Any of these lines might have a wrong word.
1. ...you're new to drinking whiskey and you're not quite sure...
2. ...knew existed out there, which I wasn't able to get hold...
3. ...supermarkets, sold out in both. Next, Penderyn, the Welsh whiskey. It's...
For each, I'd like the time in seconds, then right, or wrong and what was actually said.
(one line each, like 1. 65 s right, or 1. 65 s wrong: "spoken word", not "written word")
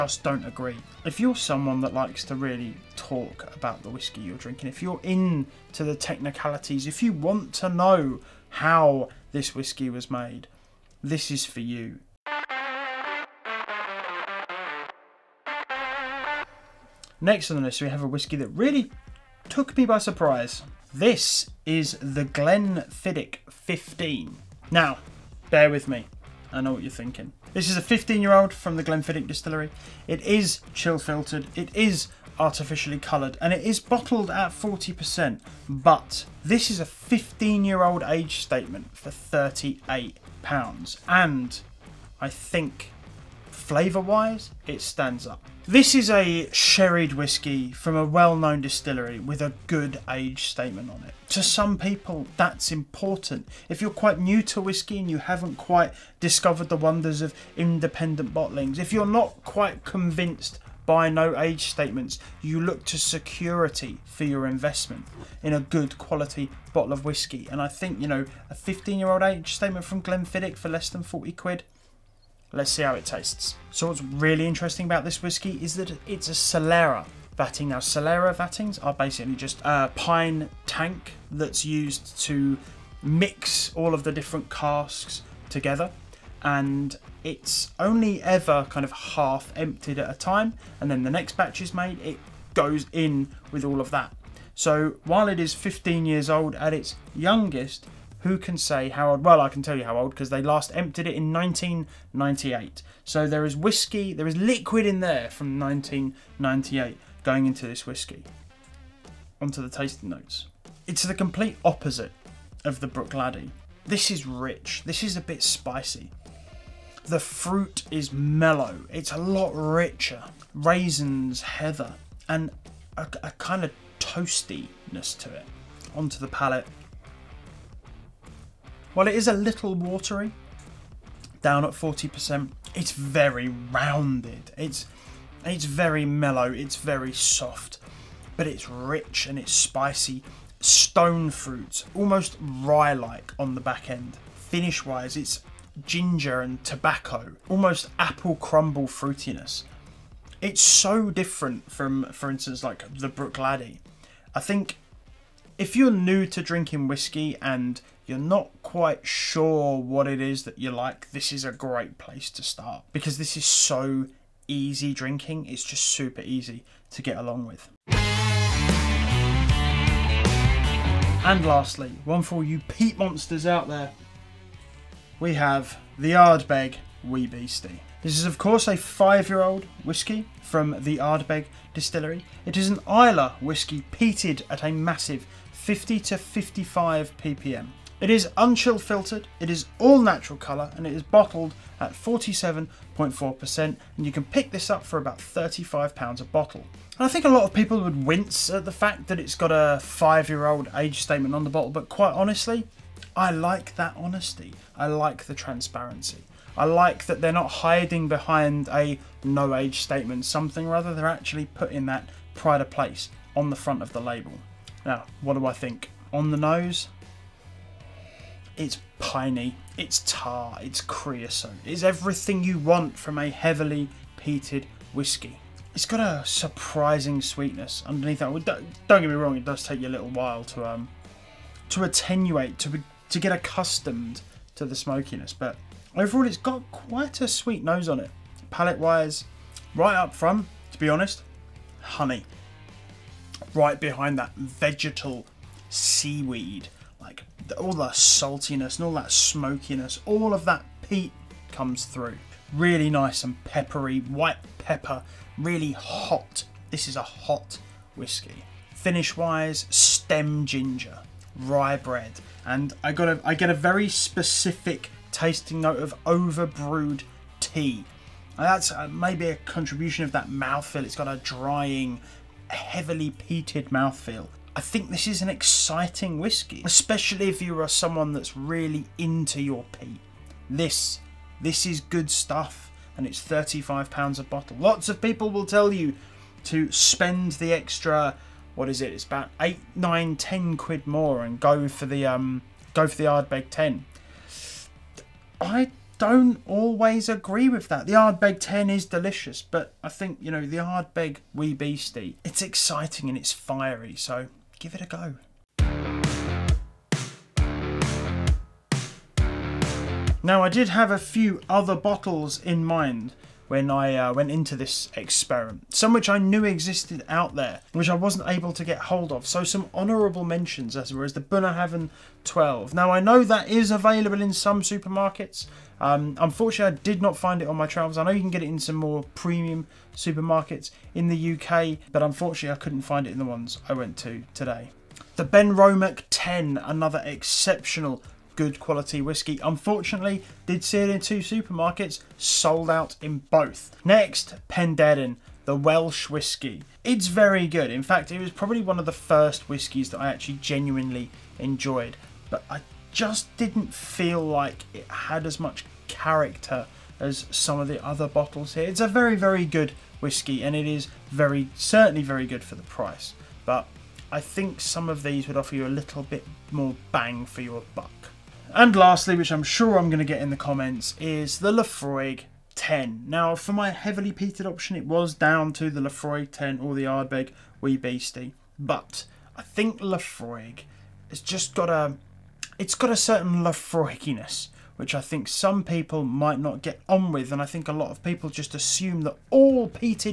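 1. 155 s right
2. 316 s right
3. 341 s right.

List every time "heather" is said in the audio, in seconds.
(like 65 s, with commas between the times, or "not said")
121 s.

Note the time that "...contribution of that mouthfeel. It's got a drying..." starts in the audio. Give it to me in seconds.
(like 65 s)
269 s.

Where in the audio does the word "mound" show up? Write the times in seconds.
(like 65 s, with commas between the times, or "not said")
not said.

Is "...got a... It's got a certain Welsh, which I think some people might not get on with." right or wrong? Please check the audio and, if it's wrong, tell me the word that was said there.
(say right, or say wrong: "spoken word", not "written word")
wrong: "Laphroaiginess", not "Welsh".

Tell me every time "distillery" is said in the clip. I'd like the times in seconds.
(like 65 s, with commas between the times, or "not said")
29 s, 48 s, 181 s.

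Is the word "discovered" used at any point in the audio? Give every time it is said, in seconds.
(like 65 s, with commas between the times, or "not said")
56 s.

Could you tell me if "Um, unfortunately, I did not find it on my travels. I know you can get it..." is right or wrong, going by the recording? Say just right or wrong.
right.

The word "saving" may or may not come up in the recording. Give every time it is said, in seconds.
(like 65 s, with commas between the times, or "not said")
not said.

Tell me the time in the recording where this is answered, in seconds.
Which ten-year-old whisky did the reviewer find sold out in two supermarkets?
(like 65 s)
335 s.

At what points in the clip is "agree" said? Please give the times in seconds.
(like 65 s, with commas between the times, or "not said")
0 s, 297 s.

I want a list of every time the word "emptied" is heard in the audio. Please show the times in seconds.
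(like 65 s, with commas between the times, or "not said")
89 s, 100 s.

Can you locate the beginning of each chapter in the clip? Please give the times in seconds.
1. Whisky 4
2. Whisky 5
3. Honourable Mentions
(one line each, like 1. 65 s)
1. 14 s
2. 169 s
3. 306 s.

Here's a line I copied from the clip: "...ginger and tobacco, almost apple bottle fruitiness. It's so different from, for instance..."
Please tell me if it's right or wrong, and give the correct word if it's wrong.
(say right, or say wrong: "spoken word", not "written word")
wrong: "crumble", not "bottle".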